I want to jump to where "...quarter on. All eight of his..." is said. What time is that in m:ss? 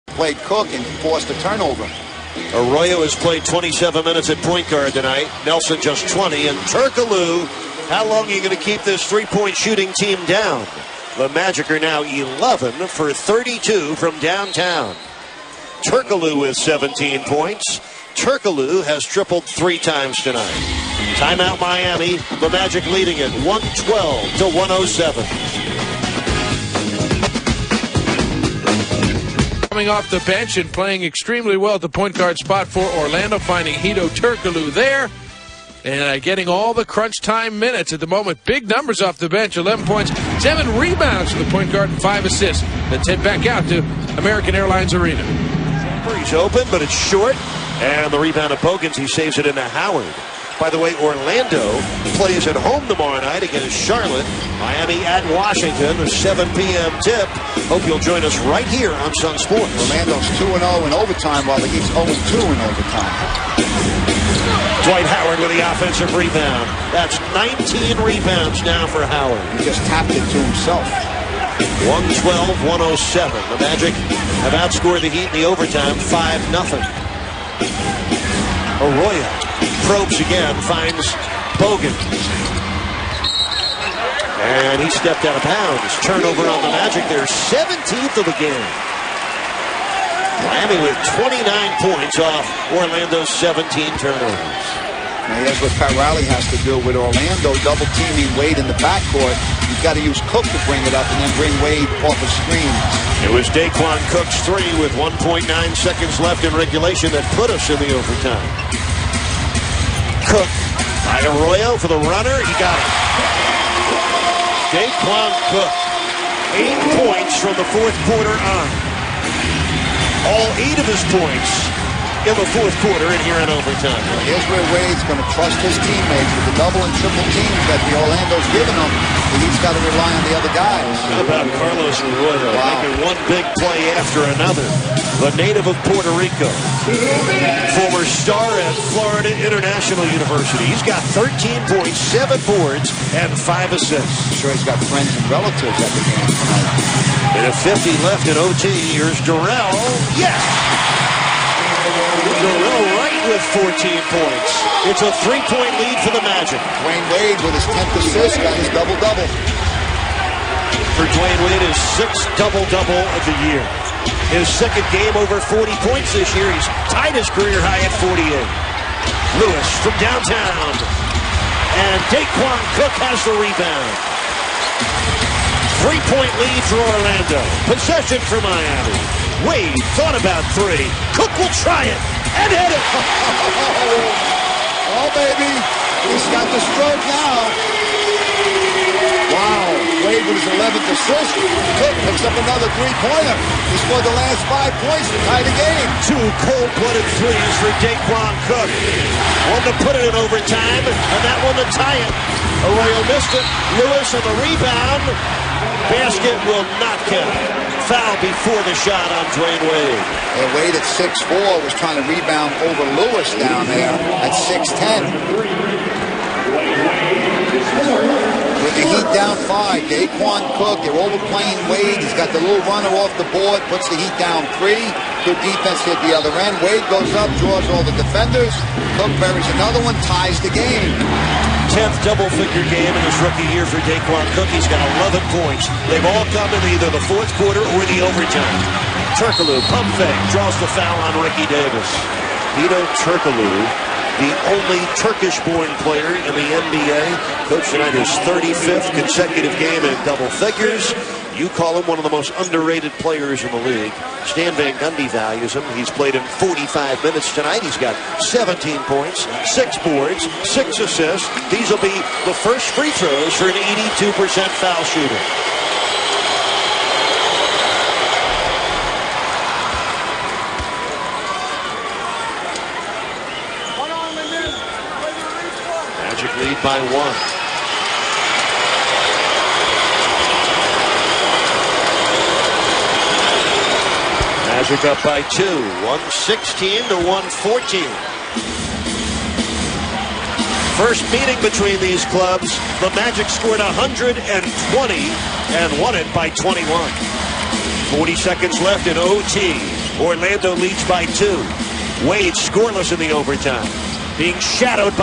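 1:58.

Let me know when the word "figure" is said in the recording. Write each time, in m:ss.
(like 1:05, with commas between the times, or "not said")
3:52, 4:10.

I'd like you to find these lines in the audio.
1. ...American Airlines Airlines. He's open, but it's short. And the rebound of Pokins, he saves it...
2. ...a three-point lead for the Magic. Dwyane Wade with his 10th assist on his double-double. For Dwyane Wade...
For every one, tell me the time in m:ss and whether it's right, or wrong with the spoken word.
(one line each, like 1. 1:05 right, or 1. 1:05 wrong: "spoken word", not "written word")
1. 0:44 wrong: "Arena", not "Airlines"
2. 2:35 right.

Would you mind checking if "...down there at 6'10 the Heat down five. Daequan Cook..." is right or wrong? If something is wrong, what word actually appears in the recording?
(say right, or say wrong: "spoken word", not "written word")
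right.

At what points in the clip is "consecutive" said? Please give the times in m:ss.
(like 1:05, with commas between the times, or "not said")
4:08.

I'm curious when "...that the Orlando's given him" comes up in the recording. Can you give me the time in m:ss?
2:07.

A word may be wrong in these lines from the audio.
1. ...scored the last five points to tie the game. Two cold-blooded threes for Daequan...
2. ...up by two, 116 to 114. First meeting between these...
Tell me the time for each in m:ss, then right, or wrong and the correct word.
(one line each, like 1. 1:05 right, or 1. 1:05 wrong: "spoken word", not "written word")
1. 3:13 right
2. 4:44 right.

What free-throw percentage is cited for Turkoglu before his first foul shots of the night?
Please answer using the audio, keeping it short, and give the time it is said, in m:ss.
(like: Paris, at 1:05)
82%, at 4:23.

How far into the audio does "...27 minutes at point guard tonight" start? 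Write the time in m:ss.
0:03.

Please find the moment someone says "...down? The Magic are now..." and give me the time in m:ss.
0:10.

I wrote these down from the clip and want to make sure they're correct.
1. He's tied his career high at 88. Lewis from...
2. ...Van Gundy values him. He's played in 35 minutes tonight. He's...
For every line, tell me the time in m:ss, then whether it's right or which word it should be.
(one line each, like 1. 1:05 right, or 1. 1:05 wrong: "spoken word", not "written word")
1. 2:46 wrong: "48", not "88"
2. 4:14 wrong: "45", not "35".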